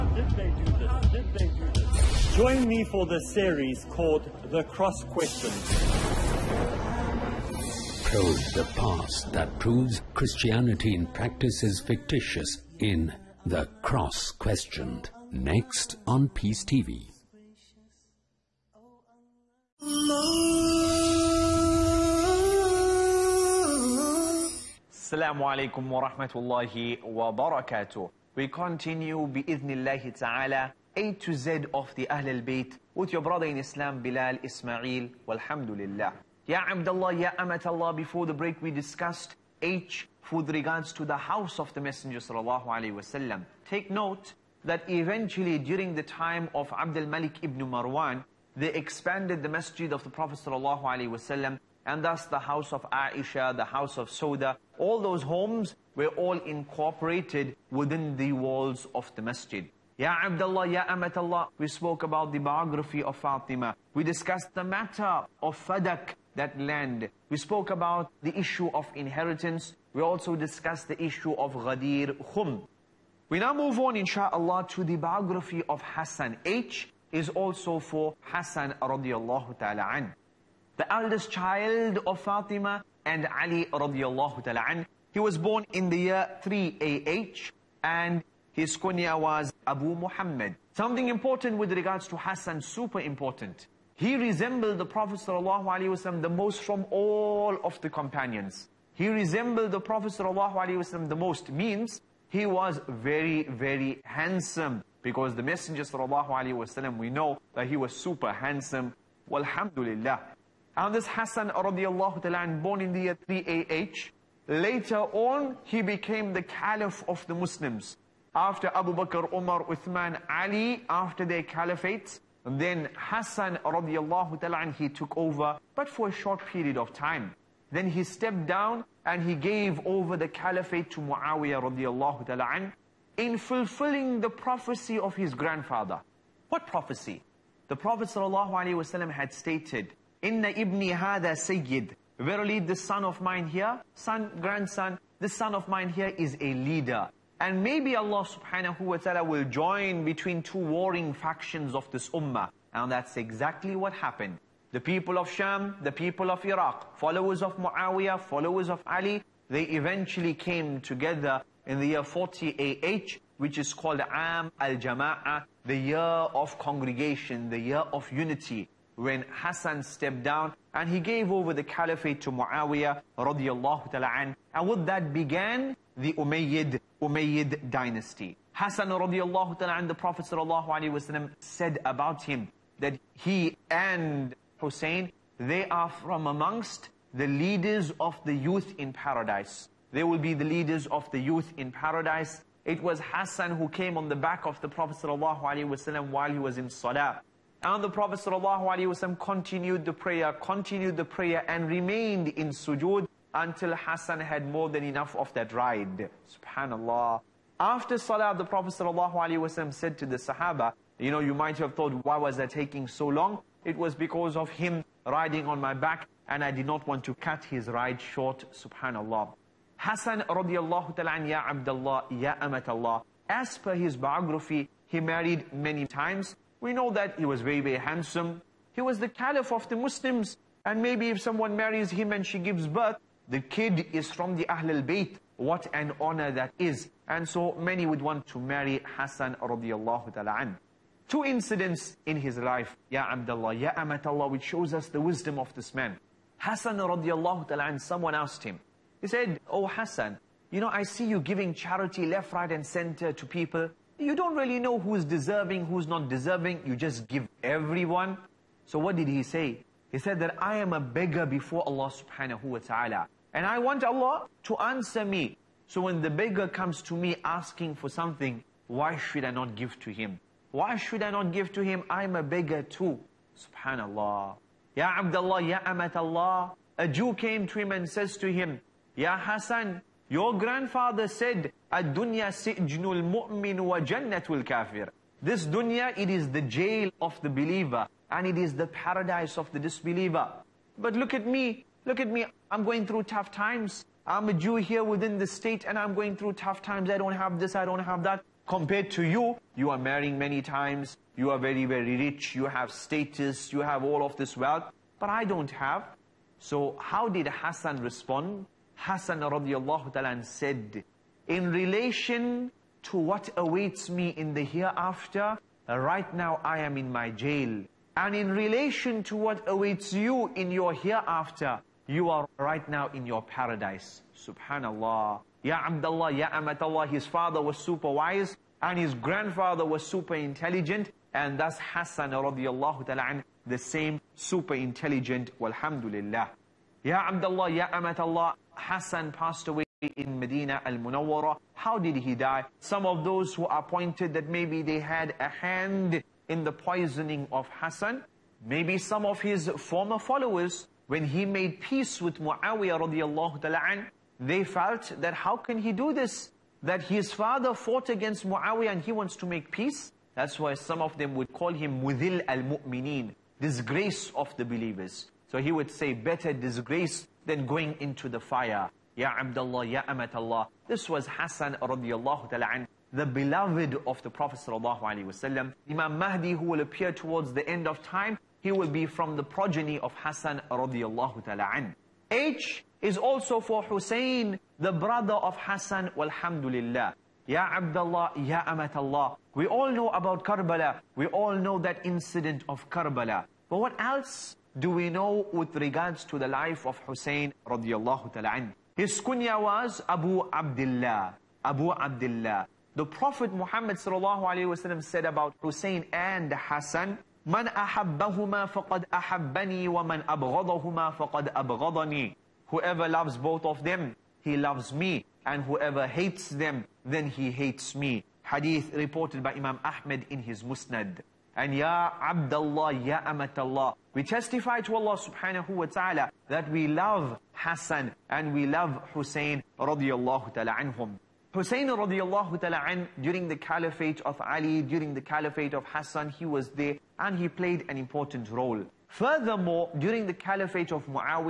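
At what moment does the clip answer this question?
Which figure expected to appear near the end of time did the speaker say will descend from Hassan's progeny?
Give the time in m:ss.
6:15.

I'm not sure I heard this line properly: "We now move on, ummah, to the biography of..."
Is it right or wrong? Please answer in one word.
wrong.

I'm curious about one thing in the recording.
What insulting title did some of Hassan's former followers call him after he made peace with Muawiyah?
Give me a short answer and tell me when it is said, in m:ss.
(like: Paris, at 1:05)
Mudil al-Mu'mineen, at 6:01.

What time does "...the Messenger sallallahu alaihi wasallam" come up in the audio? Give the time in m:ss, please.
0:41.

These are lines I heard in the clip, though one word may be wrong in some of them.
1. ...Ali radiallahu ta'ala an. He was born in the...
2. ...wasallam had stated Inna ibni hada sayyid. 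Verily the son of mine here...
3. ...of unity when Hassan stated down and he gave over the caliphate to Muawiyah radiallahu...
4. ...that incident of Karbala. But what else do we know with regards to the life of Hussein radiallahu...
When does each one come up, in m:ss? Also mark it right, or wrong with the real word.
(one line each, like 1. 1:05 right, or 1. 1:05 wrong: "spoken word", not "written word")
1. 1:23 right
2. 2:18 right
3. 2:47 wrong: "stepped", not "stated"
4. 6:31 right.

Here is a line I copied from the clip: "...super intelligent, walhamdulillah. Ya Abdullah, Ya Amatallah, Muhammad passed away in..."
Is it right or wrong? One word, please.
wrong.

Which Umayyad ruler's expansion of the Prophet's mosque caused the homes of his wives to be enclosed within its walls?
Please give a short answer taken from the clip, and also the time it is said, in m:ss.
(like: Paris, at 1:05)
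Abdul Malik ibn Marwan, at 0:46.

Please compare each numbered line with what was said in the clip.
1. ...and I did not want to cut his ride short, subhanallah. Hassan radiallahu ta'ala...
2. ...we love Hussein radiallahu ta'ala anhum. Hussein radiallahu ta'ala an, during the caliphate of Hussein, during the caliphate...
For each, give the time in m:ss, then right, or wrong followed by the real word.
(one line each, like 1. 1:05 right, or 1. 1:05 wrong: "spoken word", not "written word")
1. 3:36 right
2. 7:08 wrong: "Ali", not "Hussein".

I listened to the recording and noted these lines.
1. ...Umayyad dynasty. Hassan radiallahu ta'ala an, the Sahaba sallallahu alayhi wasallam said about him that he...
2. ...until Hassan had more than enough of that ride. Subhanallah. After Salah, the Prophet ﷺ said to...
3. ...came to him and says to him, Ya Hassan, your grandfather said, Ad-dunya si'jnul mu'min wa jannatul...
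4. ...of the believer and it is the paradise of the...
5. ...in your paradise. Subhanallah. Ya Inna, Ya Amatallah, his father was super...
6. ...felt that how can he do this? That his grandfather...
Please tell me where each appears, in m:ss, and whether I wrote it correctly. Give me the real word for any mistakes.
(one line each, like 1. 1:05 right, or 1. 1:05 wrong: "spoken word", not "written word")
1. 2:57 wrong: "Prophet", not "Sahaba"
2. 3:23 right
3. 4:37 right
4. 4:47 right
5. 5:22 wrong: "Abdullah", not "Inna"
6. 5:54 wrong: "father", not "grandfather".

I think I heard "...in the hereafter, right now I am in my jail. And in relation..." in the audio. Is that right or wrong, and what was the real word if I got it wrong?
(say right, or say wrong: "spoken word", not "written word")
right.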